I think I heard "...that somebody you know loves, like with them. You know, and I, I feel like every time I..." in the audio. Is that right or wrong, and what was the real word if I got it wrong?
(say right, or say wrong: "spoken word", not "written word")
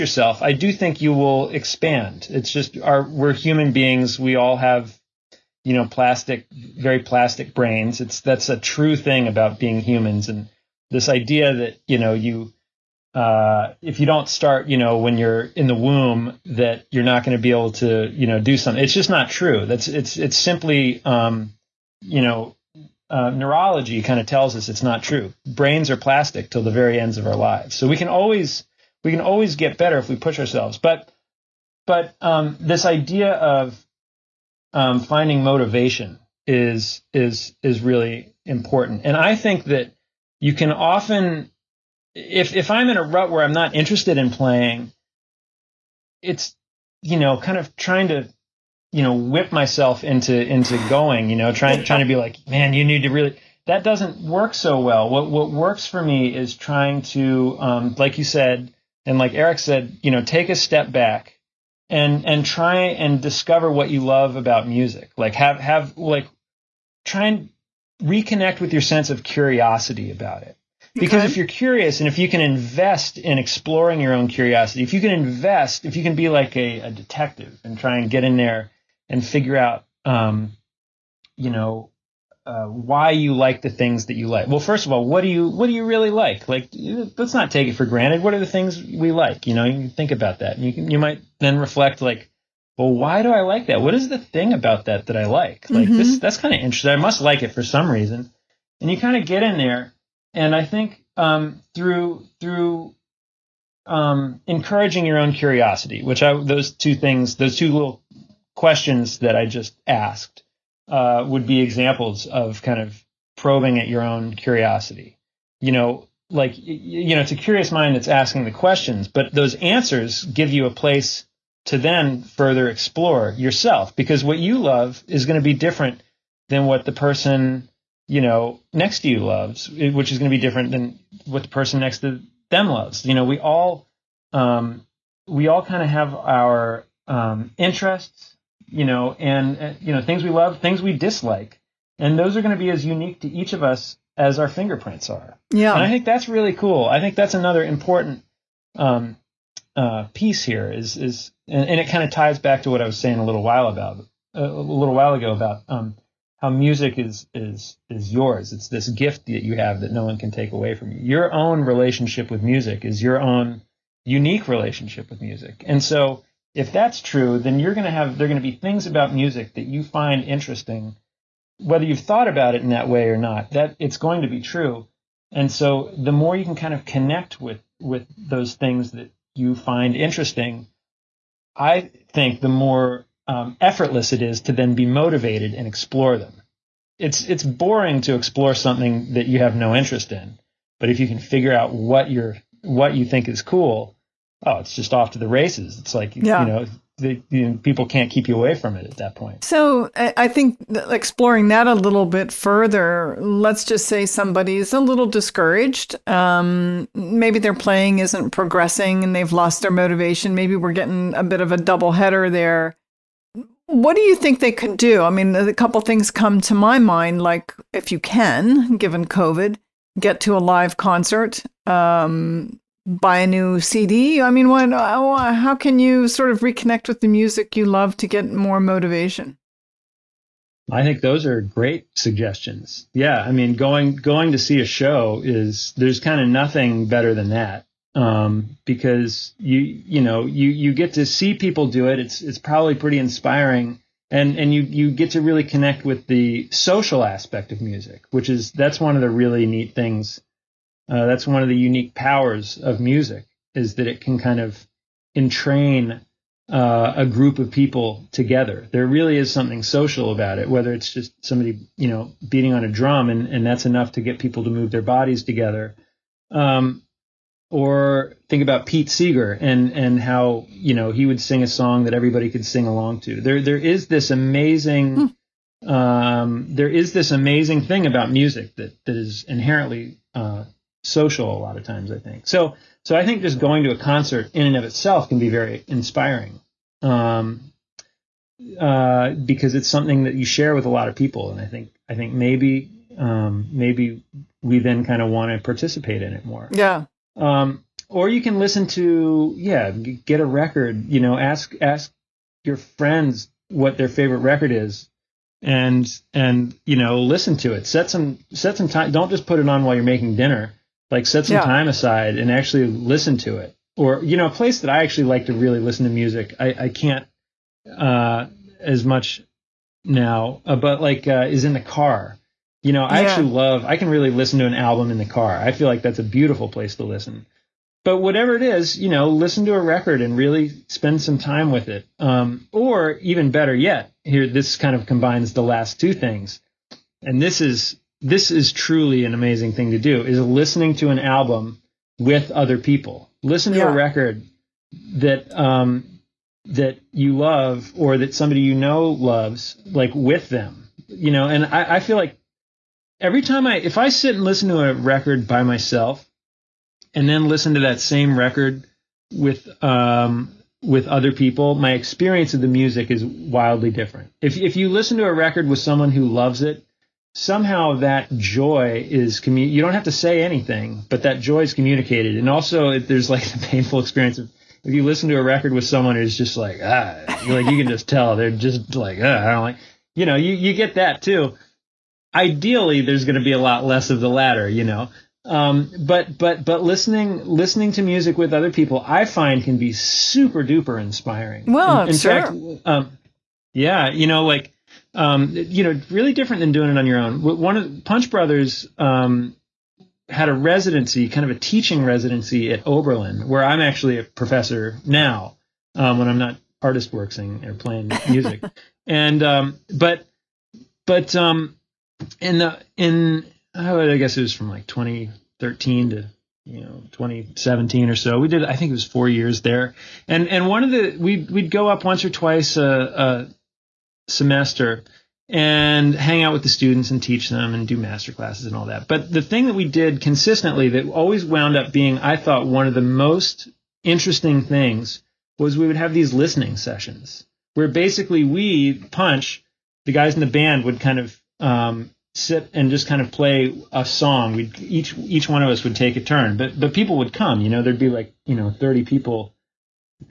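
right.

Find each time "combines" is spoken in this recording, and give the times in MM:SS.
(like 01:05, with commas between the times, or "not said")
05:34.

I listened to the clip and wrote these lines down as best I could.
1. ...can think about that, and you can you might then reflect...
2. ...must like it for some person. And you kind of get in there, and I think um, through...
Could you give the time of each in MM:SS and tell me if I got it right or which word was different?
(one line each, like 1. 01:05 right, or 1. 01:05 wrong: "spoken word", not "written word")
1. 01:29 right
2. 01:36 wrong: "reason", not "person".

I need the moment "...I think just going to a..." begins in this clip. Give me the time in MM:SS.
04:42.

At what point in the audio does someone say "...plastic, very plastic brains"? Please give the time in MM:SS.
00:05.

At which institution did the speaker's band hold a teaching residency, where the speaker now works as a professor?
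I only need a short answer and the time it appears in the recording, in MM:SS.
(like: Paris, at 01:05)
Oberlin, at 06:42.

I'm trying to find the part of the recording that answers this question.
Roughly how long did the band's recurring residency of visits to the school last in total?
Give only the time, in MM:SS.
06:58.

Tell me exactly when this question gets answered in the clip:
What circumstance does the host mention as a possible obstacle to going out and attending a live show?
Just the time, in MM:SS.
03:39.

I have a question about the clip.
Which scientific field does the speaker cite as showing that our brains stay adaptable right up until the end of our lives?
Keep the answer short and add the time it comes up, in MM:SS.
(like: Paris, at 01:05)
neurology, at 00:23.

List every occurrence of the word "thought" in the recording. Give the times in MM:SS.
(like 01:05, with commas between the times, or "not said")
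02:51, 07:12.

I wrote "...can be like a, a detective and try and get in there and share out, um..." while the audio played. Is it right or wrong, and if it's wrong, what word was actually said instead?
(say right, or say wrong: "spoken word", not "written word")
wrong: "figure", not "share".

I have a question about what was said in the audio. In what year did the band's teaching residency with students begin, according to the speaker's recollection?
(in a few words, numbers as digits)
2013.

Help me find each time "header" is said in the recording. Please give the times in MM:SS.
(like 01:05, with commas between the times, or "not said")
03:31.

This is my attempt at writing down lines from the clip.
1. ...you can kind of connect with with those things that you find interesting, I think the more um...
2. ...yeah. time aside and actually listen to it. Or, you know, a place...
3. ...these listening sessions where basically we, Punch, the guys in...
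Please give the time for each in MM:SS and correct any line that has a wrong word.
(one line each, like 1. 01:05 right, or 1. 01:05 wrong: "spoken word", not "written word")
1. 02:56 right
2. 05:11 right
3. 07:15 right.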